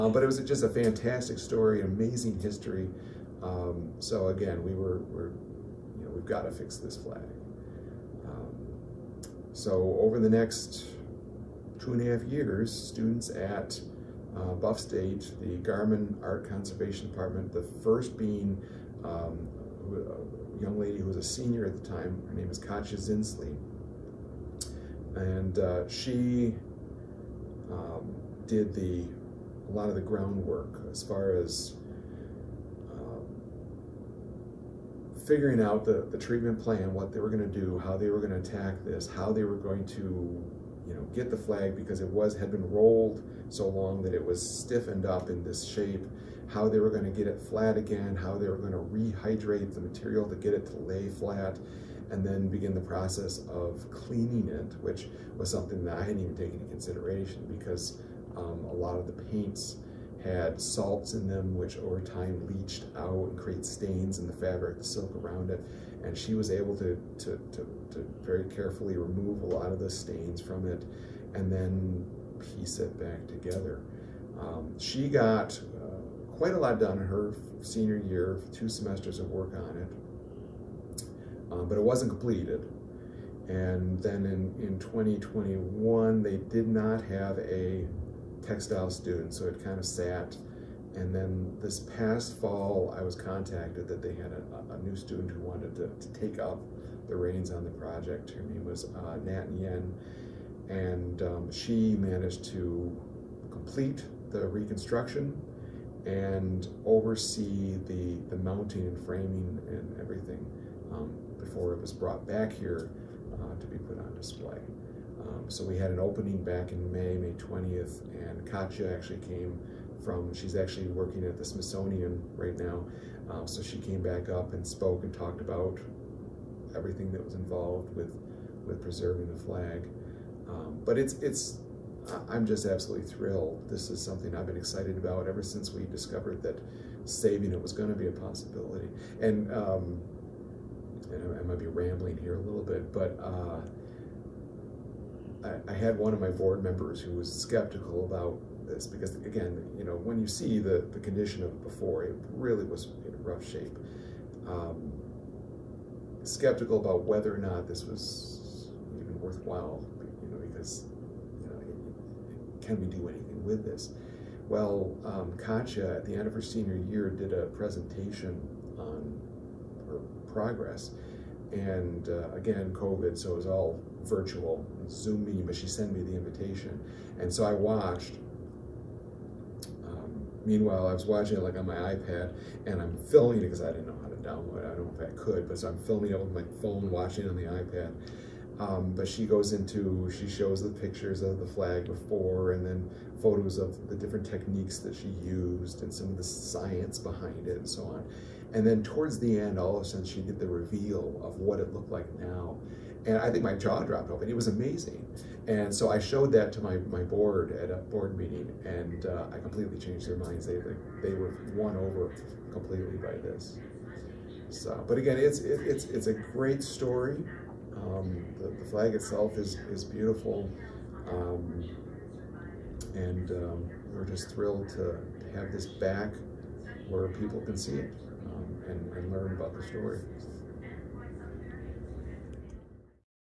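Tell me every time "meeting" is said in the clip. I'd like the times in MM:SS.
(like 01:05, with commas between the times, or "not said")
02:55, 03:28.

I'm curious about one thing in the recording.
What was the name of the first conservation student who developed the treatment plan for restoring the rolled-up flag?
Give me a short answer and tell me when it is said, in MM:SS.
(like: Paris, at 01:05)
Katja Zinsley, at 00:22.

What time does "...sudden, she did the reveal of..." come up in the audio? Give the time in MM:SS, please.
03:19.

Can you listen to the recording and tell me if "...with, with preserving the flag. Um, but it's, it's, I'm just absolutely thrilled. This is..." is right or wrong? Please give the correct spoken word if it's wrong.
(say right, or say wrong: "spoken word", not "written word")
right.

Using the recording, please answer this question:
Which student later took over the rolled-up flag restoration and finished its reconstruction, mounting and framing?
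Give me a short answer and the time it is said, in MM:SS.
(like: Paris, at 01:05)
Nat Nguyen, at 01:39.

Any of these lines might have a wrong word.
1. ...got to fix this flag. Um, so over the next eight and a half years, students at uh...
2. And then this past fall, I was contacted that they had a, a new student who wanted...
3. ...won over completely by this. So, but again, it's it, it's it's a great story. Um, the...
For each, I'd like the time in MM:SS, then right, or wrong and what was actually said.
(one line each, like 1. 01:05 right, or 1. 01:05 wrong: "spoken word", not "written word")
1. 00:06 wrong: "two", not "eight"
2. 01:30 right
3. 03:31 right.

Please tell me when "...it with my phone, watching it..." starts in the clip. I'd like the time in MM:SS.
03:06.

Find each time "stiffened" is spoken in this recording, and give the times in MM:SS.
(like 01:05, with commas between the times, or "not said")
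00:44.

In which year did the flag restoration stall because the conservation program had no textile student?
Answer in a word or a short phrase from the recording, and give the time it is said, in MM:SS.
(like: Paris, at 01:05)
2021, at 01:24.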